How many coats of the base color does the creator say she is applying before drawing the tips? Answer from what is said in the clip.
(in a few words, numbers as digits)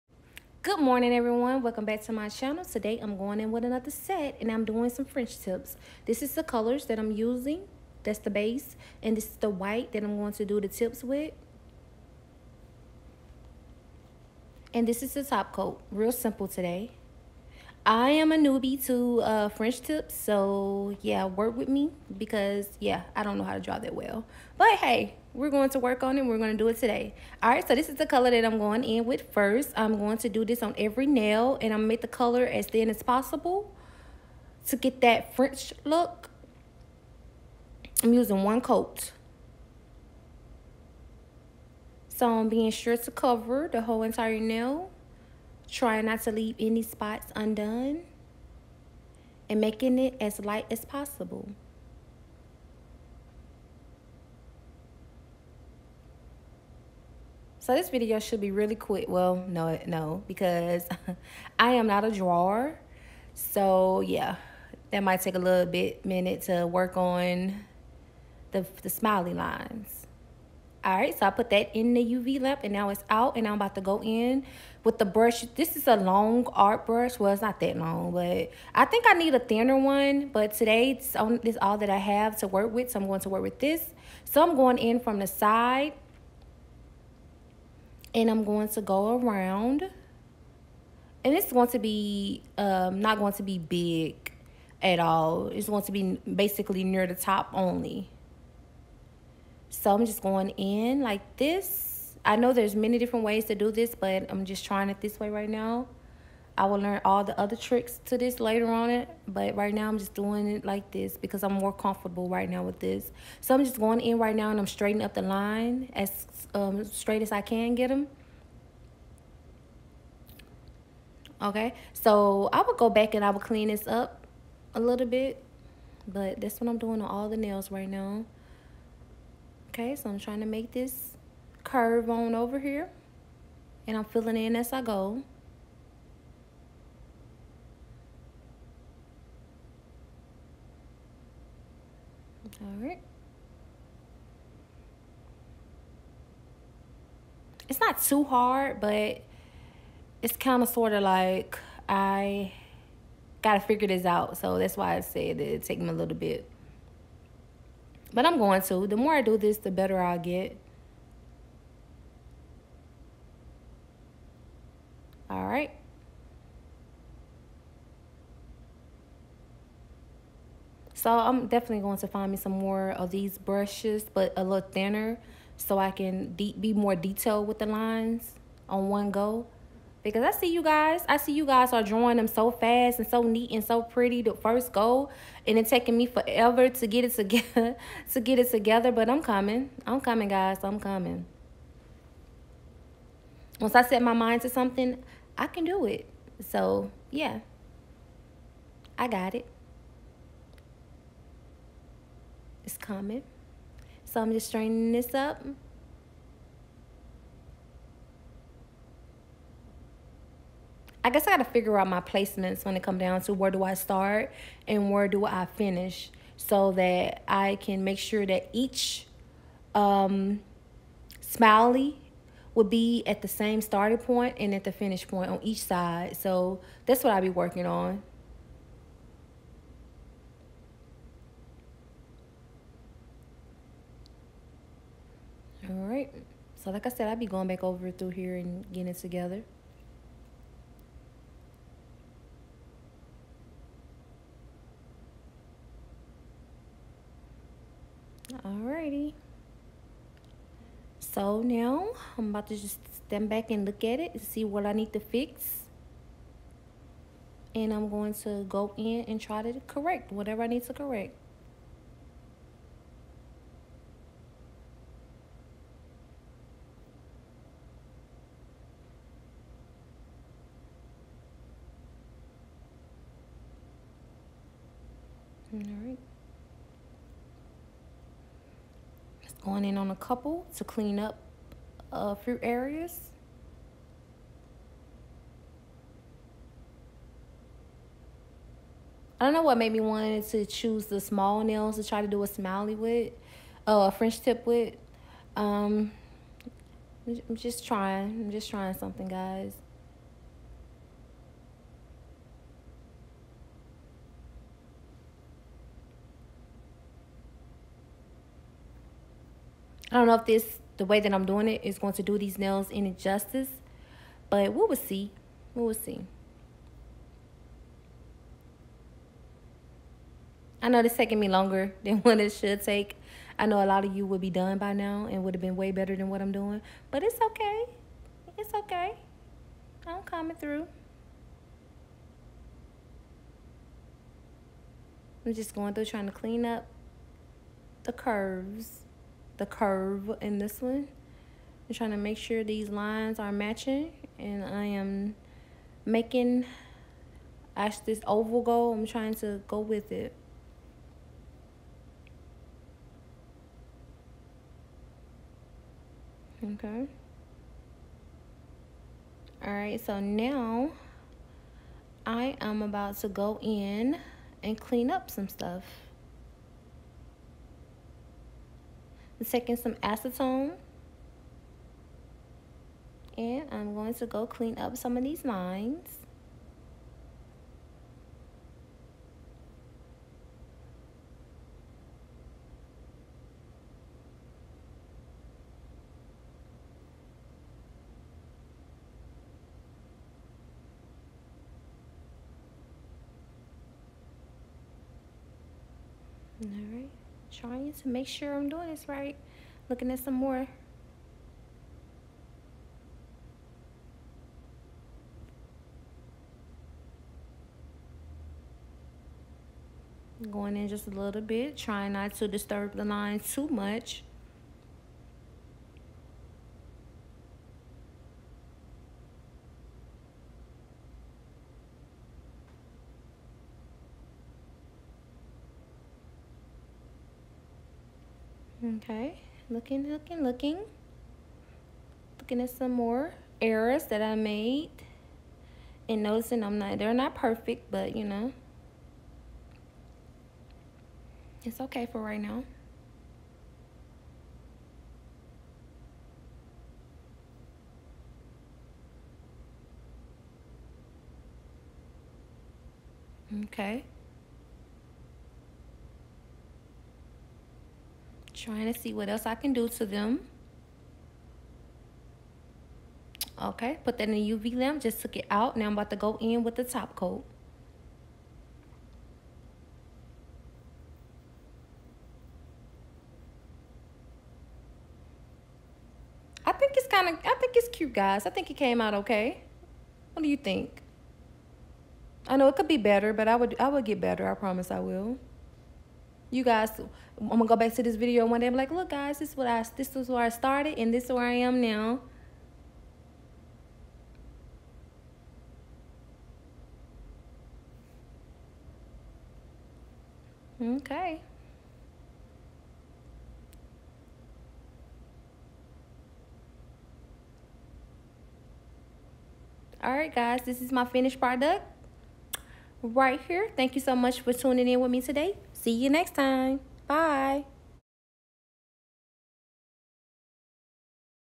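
1.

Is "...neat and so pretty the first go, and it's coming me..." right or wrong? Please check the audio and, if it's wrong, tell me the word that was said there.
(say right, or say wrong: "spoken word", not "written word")
wrong: "taking", not "coming".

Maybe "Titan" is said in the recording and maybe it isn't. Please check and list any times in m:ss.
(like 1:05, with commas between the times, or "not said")
not said.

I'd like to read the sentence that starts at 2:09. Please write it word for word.
Okay, so I'm trying to make this curve on over here.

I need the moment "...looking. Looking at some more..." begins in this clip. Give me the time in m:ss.
7:10.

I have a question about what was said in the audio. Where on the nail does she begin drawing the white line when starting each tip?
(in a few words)
from the side.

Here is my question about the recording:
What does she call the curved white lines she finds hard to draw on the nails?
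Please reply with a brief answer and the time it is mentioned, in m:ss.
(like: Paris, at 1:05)
smiley lines, at 1:08.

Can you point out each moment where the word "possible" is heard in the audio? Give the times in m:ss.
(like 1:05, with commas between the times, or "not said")
0:33, 0:50.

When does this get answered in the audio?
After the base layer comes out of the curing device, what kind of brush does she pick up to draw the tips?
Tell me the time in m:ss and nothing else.
1:15.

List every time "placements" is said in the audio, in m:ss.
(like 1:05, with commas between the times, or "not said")
3:32.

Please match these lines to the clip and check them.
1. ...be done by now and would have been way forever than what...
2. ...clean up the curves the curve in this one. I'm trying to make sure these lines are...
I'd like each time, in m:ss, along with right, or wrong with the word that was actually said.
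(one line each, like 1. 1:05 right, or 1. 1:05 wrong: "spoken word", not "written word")
1. 5:24 wrong: "better", not "forever"
2. 5:36 right.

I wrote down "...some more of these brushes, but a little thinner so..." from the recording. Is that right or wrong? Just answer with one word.
right.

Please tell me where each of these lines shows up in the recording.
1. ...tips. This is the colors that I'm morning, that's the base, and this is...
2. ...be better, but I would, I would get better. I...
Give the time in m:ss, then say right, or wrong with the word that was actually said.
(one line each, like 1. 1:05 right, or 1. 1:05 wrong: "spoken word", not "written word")
1. 0:05 wrong: "using", not "morning"
2. 8:02 right.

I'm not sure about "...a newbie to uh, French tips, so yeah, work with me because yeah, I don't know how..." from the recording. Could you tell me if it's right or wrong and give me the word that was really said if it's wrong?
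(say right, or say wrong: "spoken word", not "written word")
right.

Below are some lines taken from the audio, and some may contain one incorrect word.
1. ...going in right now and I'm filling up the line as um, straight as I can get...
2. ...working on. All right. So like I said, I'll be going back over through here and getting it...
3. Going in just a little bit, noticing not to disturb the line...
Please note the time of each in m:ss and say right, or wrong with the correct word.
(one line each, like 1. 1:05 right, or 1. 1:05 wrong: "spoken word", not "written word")
1. 1:53 wrong: "straightening", not "filling"
2. 3:47 right
3. 6:50 wrong: "trying", not "noticing".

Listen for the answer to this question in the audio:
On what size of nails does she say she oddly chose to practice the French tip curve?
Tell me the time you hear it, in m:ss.
4:50.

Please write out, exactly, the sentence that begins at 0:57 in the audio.
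So this video should be really quick.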